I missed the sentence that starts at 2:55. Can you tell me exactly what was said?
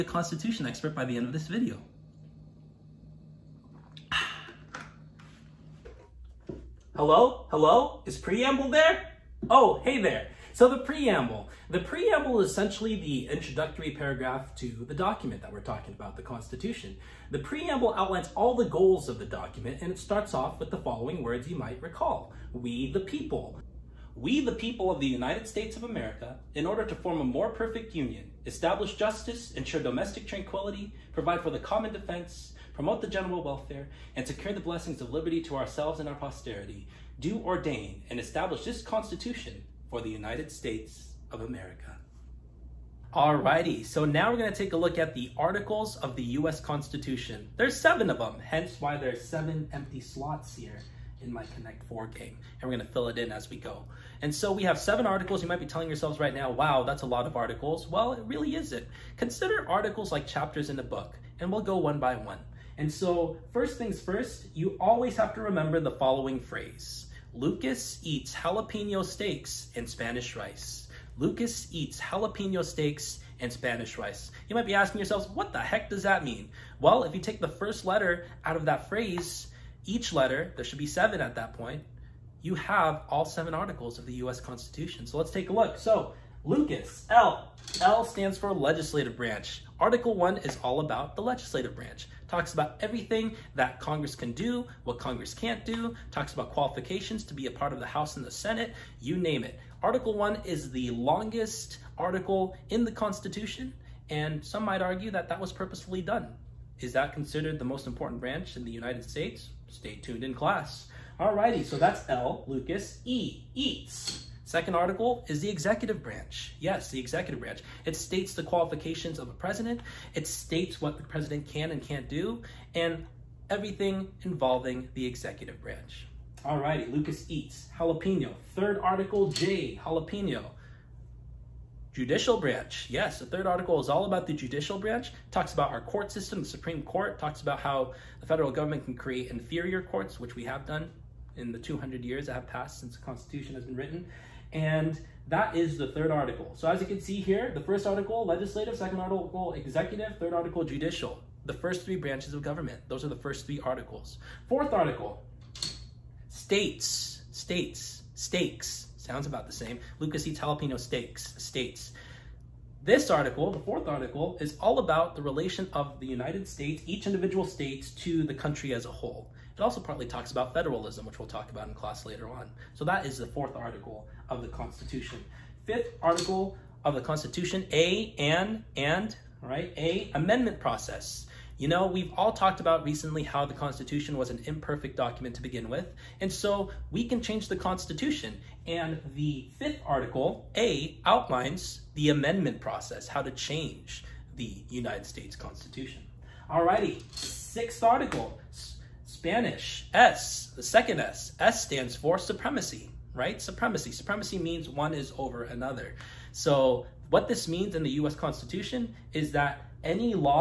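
Fifth article of the Constitution, A and, and, all right, A, amendment process.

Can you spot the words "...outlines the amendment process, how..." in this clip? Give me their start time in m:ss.
3:11.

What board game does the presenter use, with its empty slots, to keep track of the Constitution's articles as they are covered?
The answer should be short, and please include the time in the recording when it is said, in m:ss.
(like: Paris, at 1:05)
Connect 4, at 0:51.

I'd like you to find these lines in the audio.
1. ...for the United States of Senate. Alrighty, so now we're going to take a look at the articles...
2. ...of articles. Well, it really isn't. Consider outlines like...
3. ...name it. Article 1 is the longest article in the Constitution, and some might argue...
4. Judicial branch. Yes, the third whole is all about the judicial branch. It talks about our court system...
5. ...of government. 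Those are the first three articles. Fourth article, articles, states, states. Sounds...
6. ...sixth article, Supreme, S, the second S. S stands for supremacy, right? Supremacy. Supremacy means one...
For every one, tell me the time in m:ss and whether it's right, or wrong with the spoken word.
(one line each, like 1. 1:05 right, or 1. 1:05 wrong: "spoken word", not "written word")
1. 0:39 wrong: "America", not "Senate"
2. 0:57 wrong: "articles", not "outlines"
3. 1:39 right
4. 2:11 wrong: "article", not "whole"
5. 2:32 wrong: "states", not "articles"
6. 3:17 wrong: "Spanish", not "Supreme".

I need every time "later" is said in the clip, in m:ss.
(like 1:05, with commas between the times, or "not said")
2:52.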